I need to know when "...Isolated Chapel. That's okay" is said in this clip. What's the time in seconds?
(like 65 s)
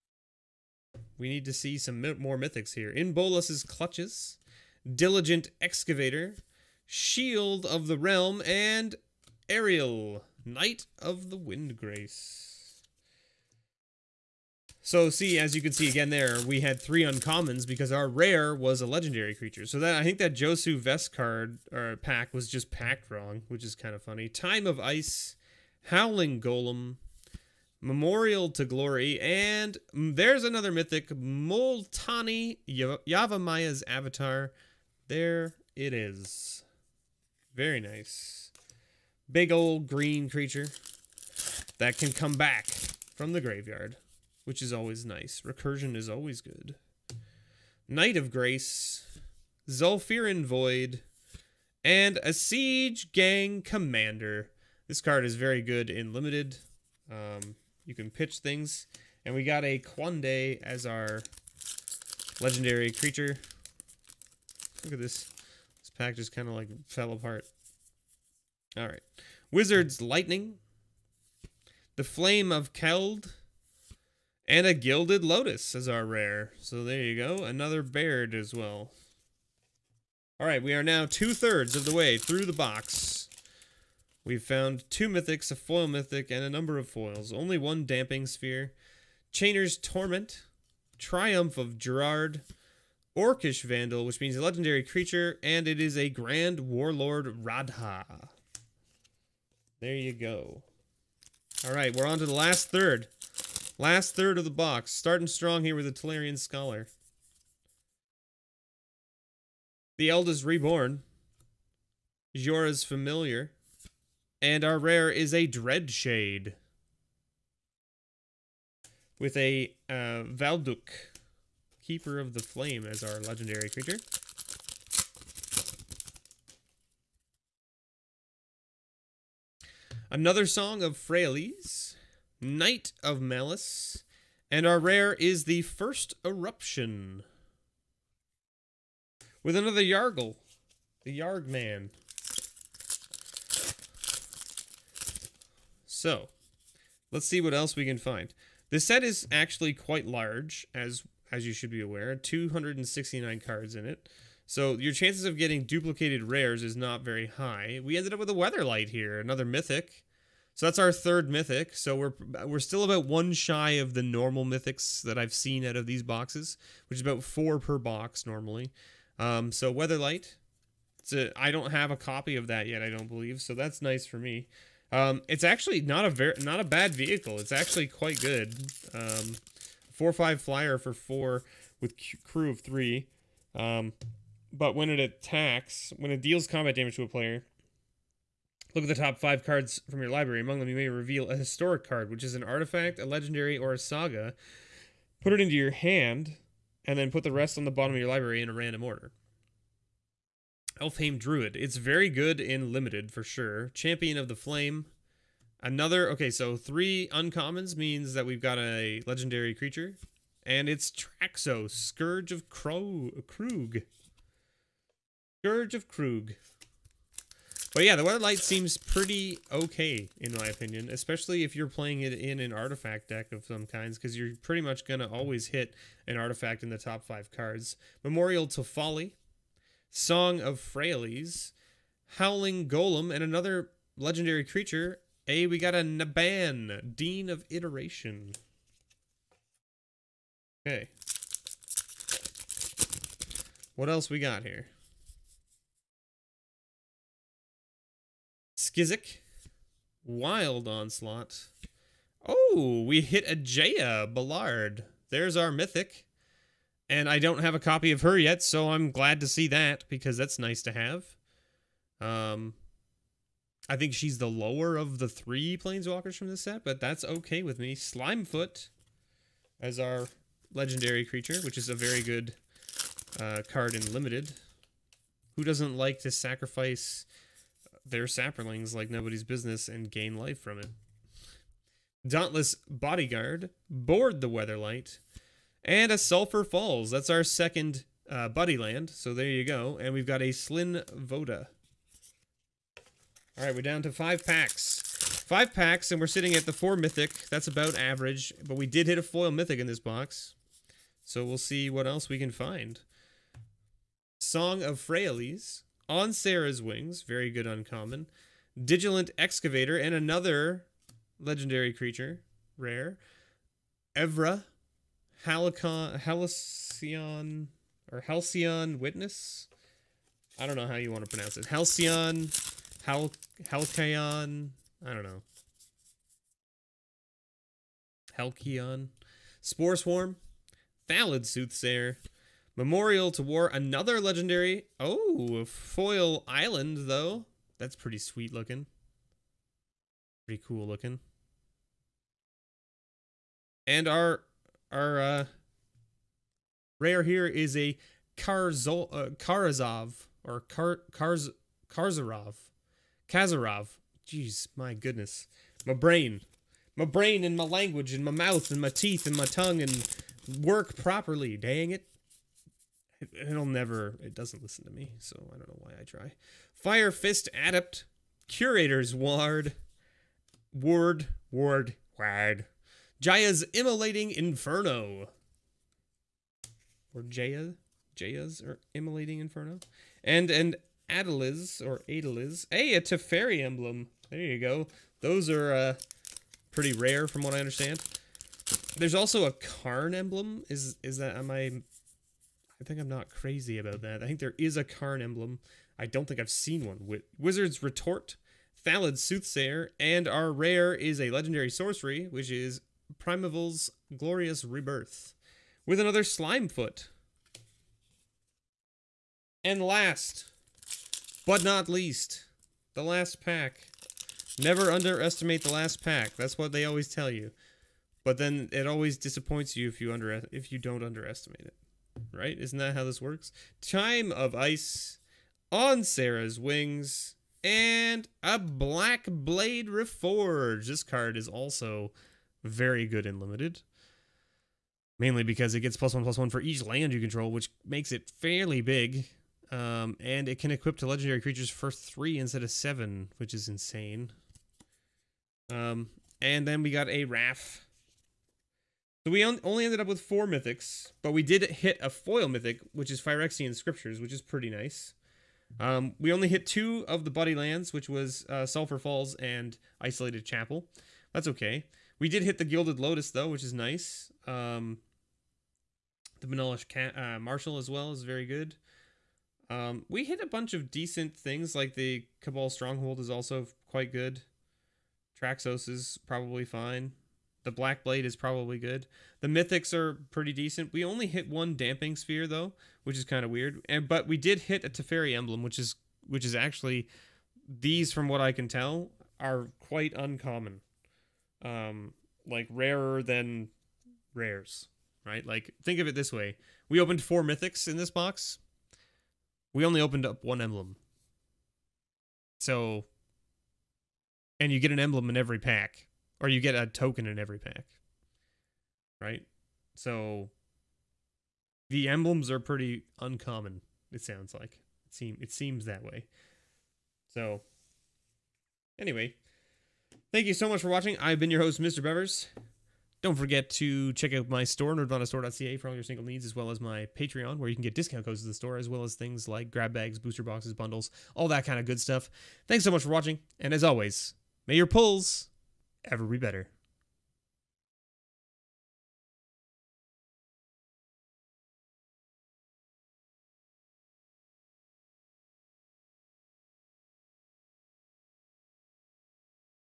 459 s.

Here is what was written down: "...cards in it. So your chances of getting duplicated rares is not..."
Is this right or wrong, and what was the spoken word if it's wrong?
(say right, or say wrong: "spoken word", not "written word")
right.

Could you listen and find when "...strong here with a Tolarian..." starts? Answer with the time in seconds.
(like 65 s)
105 s.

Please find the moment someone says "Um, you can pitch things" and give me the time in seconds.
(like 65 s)
57 s.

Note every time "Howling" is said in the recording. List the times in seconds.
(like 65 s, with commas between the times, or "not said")
25 s, 232 s.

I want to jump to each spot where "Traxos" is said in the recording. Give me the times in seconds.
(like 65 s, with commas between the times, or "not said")
210 s, 475 s.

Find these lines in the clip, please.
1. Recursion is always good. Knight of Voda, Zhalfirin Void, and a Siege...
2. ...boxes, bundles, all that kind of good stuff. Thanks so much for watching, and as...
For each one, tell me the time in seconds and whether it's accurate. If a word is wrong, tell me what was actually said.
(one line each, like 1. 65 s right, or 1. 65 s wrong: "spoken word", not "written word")
1. 45 s wrong: "Grace", not "Voda"
2. 530 s right.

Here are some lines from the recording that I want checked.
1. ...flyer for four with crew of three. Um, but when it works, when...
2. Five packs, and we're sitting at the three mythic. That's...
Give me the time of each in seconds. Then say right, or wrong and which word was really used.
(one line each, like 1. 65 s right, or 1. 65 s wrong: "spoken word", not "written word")
1. 180 s wrong: "attacks", not "works"
2. 295 s wrong: "four", not "three".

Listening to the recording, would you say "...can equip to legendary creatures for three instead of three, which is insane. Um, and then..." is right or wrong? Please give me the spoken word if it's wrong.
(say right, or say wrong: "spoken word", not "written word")
wrong: "seven", not "three".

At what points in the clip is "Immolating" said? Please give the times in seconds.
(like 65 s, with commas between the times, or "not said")
373 s, 378 s.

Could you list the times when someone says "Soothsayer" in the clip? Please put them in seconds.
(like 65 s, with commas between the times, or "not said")
331 s, 398 s.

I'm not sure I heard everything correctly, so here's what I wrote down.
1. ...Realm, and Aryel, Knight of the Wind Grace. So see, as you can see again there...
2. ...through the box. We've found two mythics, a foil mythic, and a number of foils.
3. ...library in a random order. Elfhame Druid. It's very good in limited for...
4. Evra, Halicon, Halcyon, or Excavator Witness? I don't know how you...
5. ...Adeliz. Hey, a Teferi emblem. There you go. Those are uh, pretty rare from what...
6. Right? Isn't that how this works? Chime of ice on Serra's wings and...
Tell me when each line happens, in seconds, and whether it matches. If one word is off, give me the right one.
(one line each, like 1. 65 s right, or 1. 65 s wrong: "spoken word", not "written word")
1. 7 s right
2. 82 s right
3. 198 s right
4. 313 s wrong: "Halcyon", not "Excavator"
5. 381 s right
6. 422 s right.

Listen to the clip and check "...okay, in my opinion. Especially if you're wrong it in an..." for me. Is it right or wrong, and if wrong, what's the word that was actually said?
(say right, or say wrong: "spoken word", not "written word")
wrong: "playing", not "wrong".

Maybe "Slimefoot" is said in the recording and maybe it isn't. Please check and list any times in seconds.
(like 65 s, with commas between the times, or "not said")
267 s, 406 s.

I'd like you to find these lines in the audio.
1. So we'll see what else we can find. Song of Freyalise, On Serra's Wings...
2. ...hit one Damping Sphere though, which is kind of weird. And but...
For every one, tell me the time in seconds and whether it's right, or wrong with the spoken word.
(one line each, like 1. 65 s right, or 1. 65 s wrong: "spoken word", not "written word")
1. 301 s right
2. 481 s right.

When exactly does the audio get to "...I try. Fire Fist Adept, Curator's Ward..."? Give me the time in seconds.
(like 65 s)
365 s.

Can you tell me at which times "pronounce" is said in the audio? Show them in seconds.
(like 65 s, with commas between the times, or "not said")
321 s.